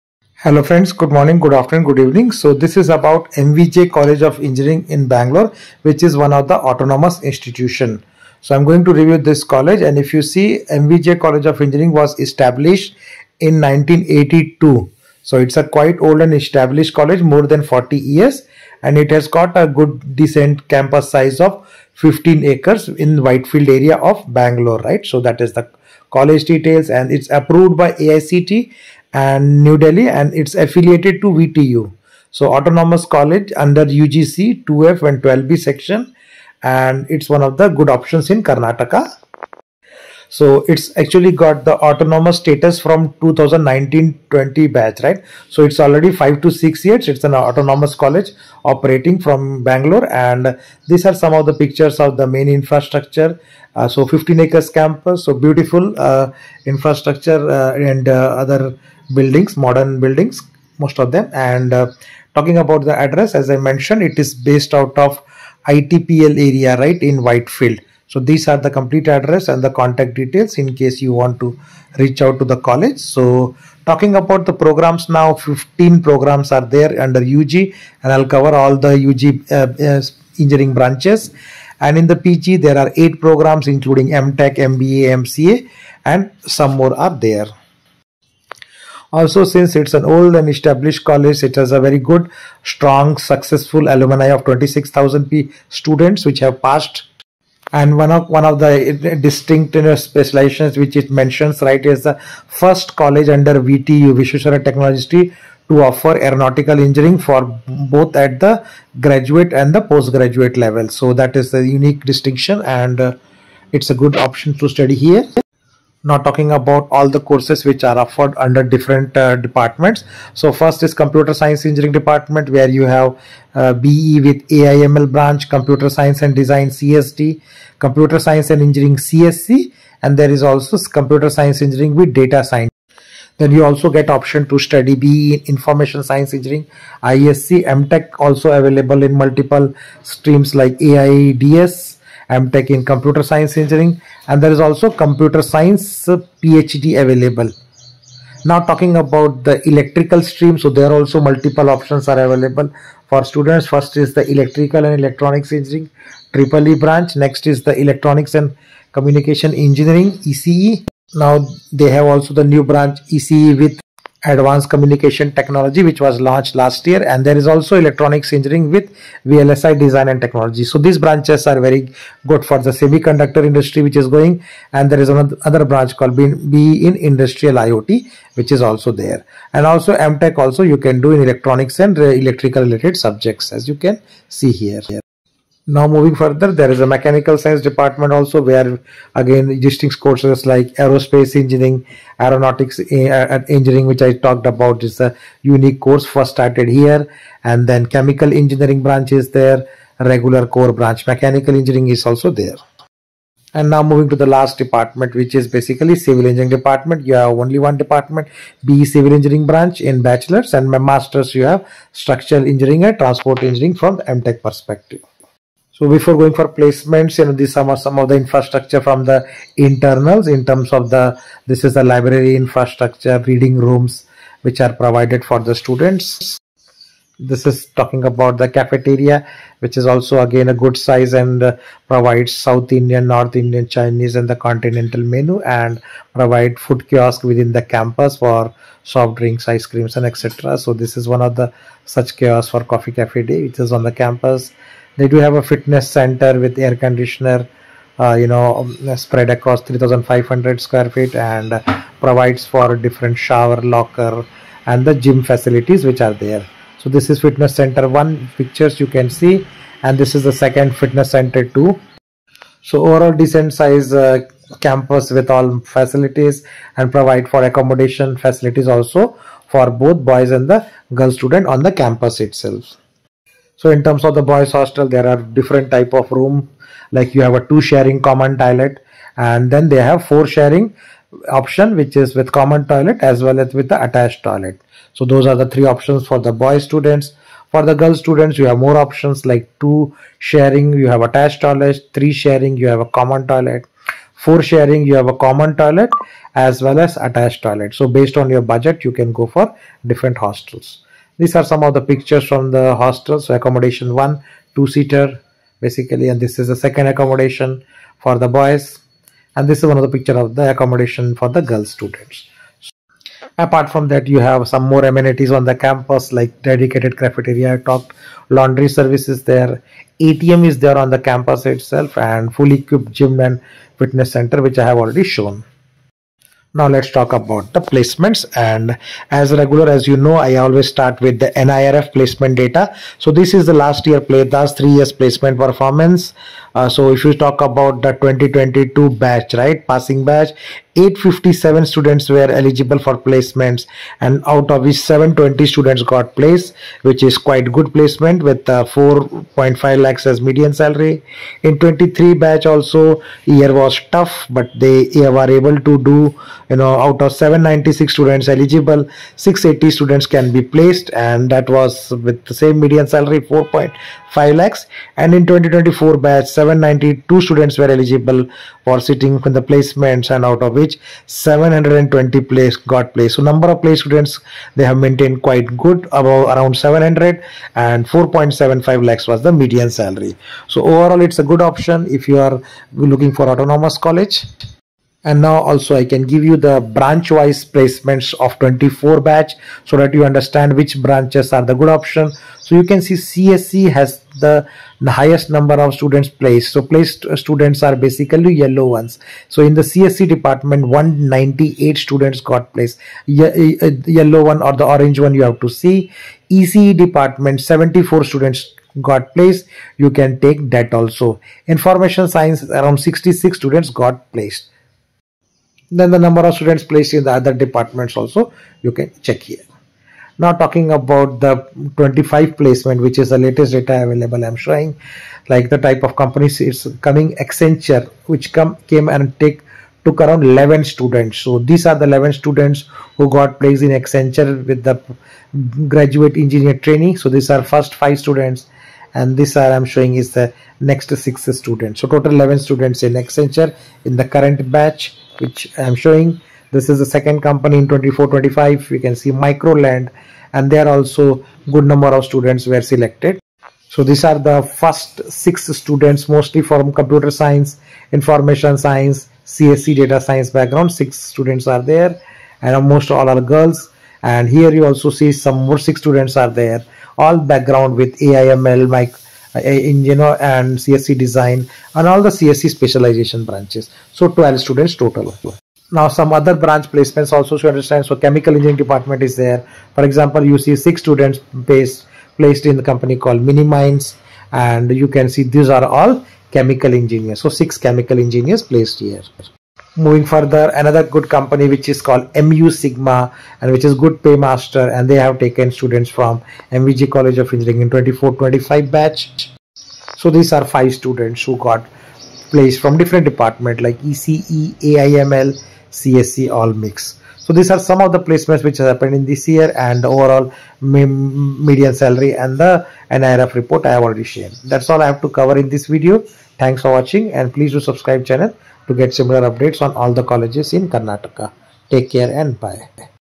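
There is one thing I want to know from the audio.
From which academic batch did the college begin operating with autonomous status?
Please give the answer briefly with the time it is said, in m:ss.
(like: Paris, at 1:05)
2019-20, at 0:43.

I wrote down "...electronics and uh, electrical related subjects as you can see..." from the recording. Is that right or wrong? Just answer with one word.
right.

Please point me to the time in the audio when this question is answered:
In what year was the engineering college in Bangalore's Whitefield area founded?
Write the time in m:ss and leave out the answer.
0:13.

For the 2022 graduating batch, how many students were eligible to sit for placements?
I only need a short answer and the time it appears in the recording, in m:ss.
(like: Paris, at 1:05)
857, at 5:40.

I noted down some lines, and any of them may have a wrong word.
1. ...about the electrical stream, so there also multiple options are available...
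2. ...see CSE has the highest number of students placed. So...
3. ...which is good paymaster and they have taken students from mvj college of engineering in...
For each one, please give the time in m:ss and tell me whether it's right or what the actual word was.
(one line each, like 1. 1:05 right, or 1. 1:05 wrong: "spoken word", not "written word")
1. 2:28 right
2. 6:32 right
3. 8:13 right.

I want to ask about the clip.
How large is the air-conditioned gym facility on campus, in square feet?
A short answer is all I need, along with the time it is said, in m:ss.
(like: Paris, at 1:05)
3,500 square feet, at 4:09.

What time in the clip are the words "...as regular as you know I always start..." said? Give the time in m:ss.
5:29.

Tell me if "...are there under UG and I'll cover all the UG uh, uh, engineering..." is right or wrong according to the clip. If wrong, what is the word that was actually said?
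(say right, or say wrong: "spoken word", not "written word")
right.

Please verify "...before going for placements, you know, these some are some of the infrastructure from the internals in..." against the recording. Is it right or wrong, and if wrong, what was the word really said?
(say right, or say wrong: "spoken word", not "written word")
right.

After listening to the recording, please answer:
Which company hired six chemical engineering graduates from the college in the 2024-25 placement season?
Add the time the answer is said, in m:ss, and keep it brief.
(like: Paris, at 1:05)
MiniMines, at 8:03.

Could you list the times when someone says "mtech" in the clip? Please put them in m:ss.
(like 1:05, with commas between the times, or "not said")
1:24, 2:17, 2:22, 2:59, 3:34.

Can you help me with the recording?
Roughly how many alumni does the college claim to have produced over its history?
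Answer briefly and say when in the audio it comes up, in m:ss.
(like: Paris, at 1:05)
26,000, at 1:34.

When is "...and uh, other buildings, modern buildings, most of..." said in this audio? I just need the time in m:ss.
0:57.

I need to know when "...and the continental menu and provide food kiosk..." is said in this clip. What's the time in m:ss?
3:54.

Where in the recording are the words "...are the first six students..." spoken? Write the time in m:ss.
7:34.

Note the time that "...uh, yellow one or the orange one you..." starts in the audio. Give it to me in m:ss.
6:43.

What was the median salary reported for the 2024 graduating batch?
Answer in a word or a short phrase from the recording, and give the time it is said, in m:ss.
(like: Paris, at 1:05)
4.75 lakhs, at 6:17.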